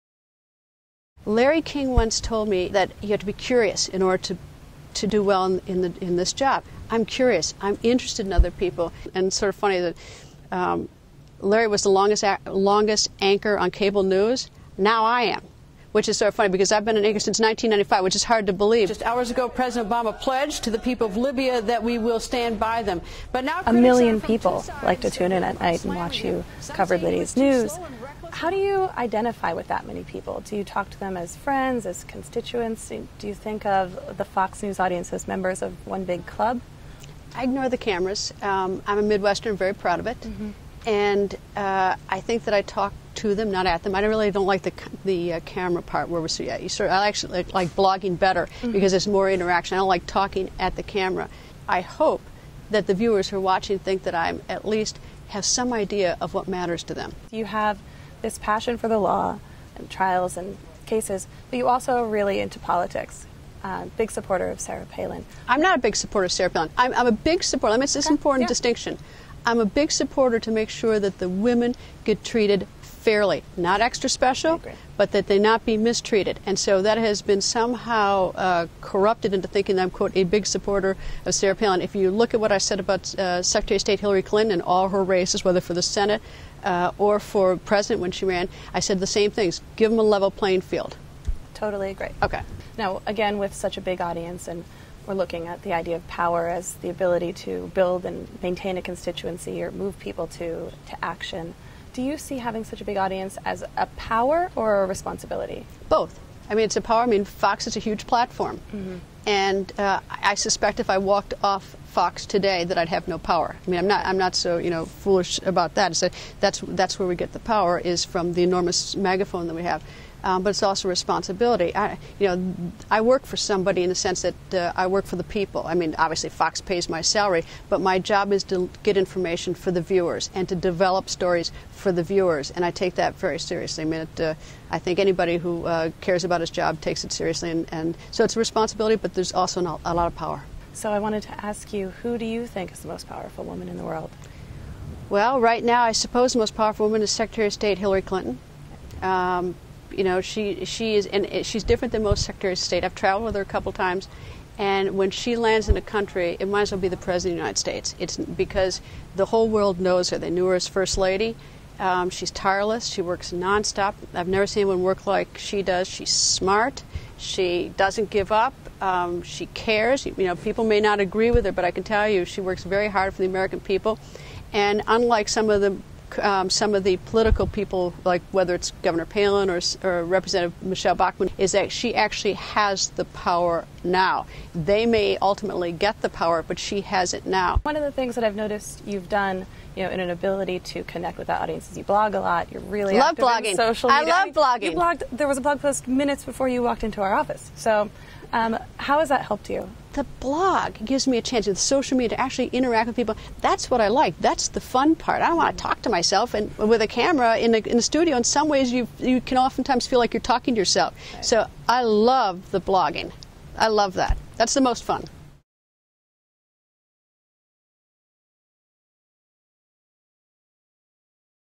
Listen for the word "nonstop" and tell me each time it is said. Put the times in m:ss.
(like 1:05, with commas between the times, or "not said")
2:43.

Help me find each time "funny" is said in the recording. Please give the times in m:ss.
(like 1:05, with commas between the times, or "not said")
0:09, 0:16.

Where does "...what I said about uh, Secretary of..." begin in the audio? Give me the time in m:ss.
1:22.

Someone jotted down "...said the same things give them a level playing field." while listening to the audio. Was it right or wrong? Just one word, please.
right.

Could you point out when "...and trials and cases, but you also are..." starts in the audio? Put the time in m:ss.
0:59.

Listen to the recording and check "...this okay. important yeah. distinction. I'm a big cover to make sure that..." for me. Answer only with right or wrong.
wrong.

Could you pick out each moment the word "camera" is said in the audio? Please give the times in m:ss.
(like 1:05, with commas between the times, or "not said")
0:37, 0:45, 0:50, 3:26.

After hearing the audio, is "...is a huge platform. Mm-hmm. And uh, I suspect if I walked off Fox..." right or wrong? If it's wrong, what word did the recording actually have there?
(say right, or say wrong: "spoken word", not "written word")
right.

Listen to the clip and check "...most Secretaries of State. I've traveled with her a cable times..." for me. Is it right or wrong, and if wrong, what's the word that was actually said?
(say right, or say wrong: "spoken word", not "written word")
wrong: "couple", not "cable".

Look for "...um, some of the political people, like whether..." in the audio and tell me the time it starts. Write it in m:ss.
2:56.